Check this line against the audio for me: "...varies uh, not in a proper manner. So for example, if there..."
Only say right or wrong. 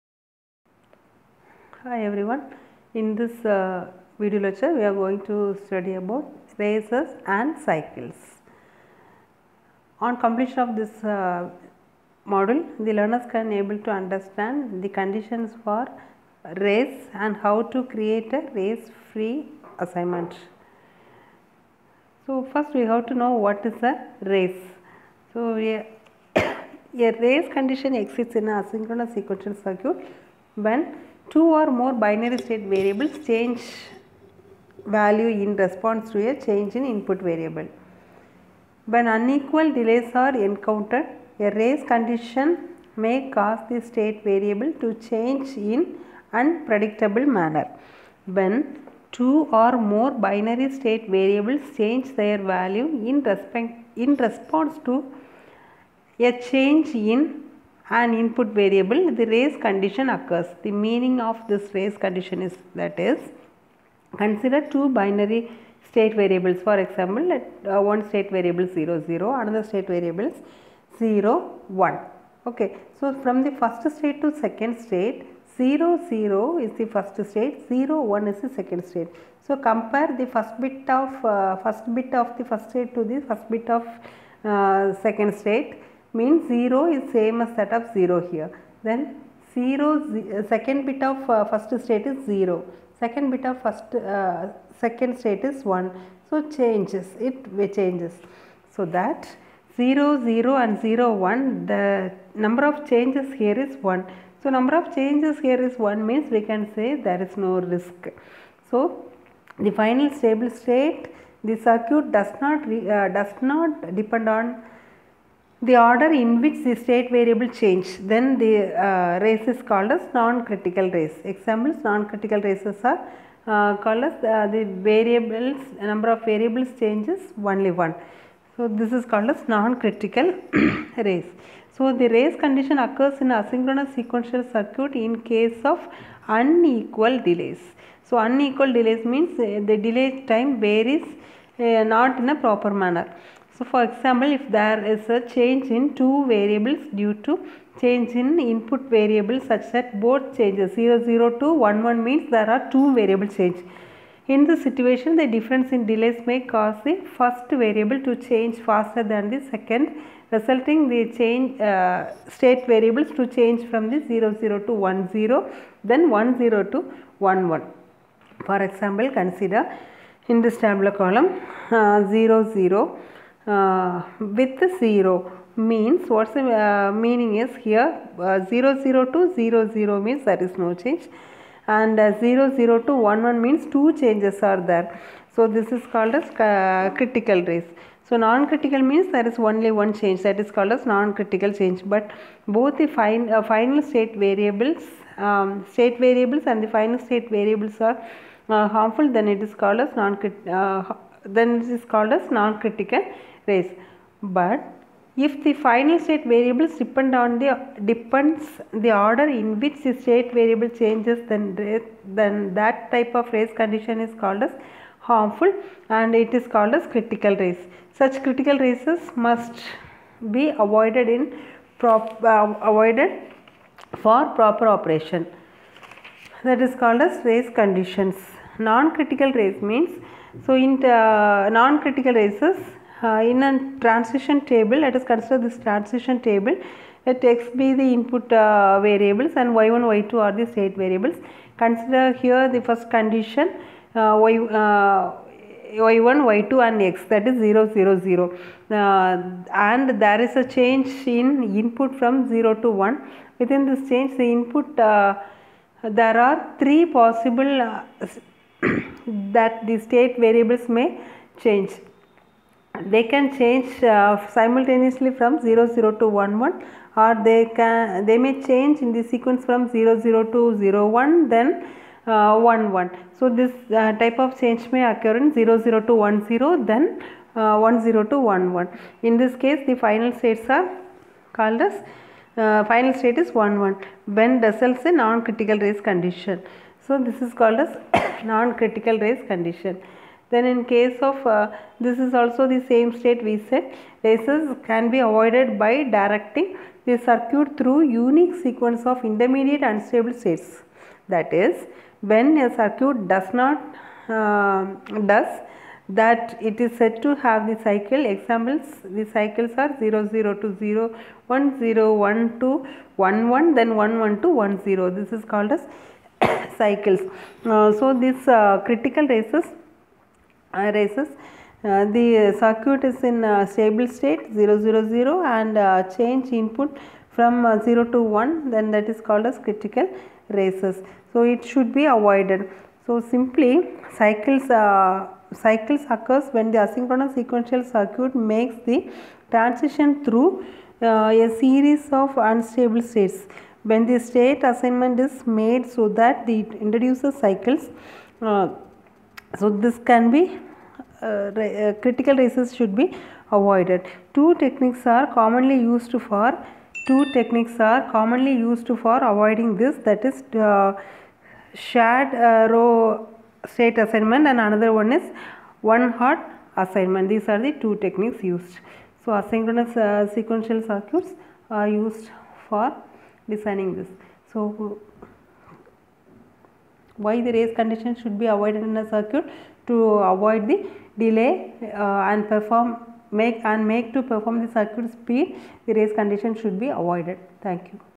right.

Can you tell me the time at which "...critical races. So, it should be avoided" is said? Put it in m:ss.
5:29.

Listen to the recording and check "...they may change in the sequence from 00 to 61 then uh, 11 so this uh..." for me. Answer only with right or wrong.
wrong.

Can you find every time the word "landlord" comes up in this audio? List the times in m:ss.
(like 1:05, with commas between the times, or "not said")
not said.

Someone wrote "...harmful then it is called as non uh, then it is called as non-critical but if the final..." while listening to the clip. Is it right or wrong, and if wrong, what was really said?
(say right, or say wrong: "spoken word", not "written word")
right.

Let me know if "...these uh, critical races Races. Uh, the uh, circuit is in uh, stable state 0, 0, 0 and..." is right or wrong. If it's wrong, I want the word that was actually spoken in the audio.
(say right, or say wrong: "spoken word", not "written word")
right.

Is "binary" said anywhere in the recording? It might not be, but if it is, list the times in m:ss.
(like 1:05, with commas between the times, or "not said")
0:32, 0:50, 1:04.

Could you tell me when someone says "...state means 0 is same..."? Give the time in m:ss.
1:25.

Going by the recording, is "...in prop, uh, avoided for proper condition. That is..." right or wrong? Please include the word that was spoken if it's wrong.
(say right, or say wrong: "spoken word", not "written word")
wrong: "operation", not "condition".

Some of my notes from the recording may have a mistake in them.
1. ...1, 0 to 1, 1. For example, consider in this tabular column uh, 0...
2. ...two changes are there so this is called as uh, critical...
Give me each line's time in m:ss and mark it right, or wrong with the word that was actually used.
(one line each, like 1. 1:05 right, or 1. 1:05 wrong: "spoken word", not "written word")
1. 2:46 right
2. 3:03 right.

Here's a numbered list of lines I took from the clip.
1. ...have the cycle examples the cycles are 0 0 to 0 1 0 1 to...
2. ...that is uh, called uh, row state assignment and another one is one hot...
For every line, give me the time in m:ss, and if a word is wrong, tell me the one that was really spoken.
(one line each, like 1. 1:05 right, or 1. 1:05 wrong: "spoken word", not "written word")
1. 5:07 right
2. 5:59 wrong: "shared", not "called".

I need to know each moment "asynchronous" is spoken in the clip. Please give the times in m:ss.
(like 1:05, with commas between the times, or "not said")
0:28, 2:13, 5:36, 6:09.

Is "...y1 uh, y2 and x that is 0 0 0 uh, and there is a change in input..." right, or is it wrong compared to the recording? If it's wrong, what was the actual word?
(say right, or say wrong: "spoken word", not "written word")
right.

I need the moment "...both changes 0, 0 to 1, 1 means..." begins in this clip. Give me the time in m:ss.
2:30.